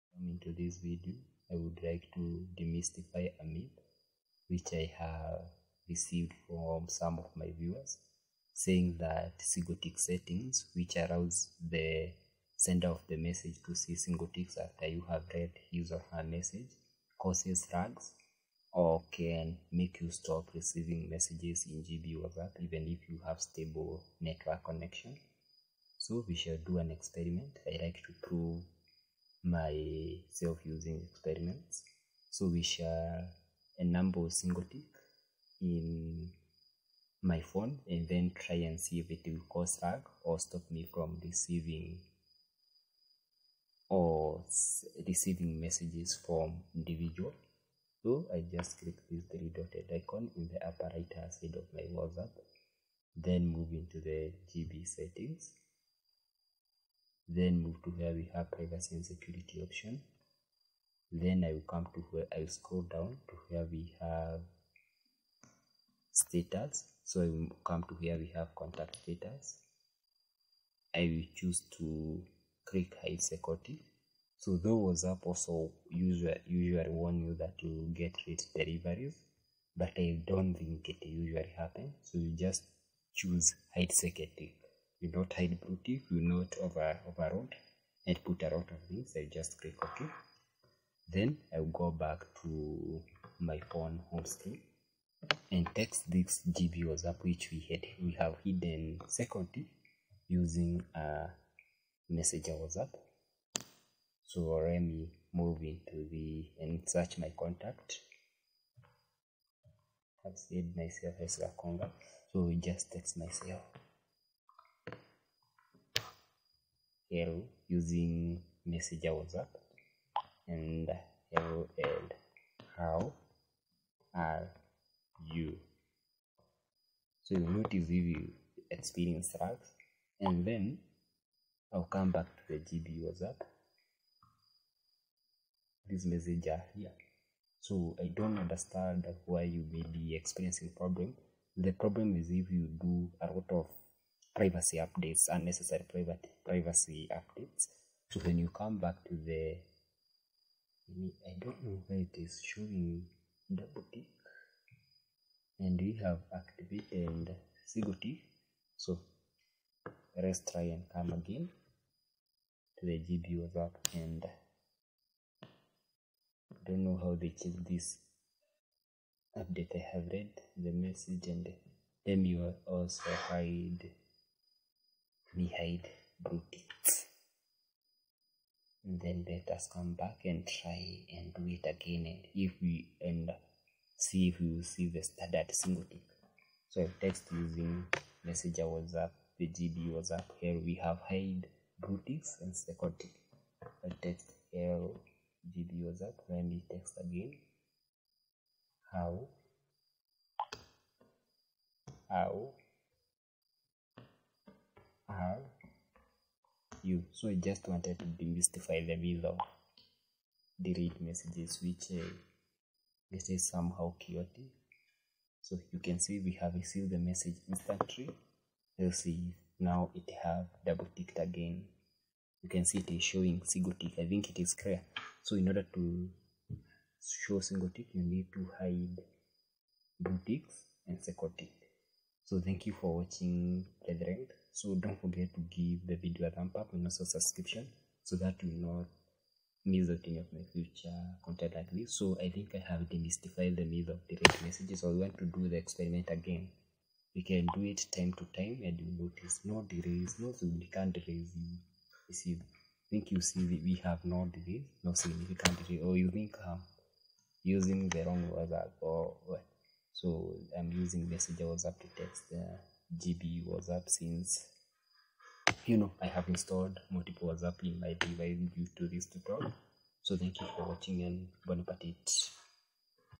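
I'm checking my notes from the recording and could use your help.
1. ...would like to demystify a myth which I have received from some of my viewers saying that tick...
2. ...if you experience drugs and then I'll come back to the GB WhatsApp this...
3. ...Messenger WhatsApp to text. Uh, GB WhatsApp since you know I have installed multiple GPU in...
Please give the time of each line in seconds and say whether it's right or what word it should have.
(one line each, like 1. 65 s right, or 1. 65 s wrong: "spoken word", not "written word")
1. 1 s right
2. 127 s right
3. 261 s wrong: "WhatsApp", not "GPU".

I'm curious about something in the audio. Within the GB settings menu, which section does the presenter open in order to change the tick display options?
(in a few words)
Privacy and security.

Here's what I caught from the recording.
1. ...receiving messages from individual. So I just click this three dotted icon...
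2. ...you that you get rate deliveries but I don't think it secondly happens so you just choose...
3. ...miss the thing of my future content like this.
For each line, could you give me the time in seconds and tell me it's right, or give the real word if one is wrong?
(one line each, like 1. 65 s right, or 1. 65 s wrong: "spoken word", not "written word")
1. 45 s right
2. 77 s wrong: "usually", not "secondly"
3. 239 s right.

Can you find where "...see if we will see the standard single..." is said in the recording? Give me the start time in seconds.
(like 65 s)
183 s.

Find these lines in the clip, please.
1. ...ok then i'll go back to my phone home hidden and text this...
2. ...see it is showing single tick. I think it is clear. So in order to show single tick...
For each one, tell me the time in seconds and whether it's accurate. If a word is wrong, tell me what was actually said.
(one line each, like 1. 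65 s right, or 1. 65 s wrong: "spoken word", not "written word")
1. 89 s wrong: "screen", not "hidden"
2. 222 s right.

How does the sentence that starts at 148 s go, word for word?
So when you come back to the, I don't know where it is showing double tick, and we have activated single tick.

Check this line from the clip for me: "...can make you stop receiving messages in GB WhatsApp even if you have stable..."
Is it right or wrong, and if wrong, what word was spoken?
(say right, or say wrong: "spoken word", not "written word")
right.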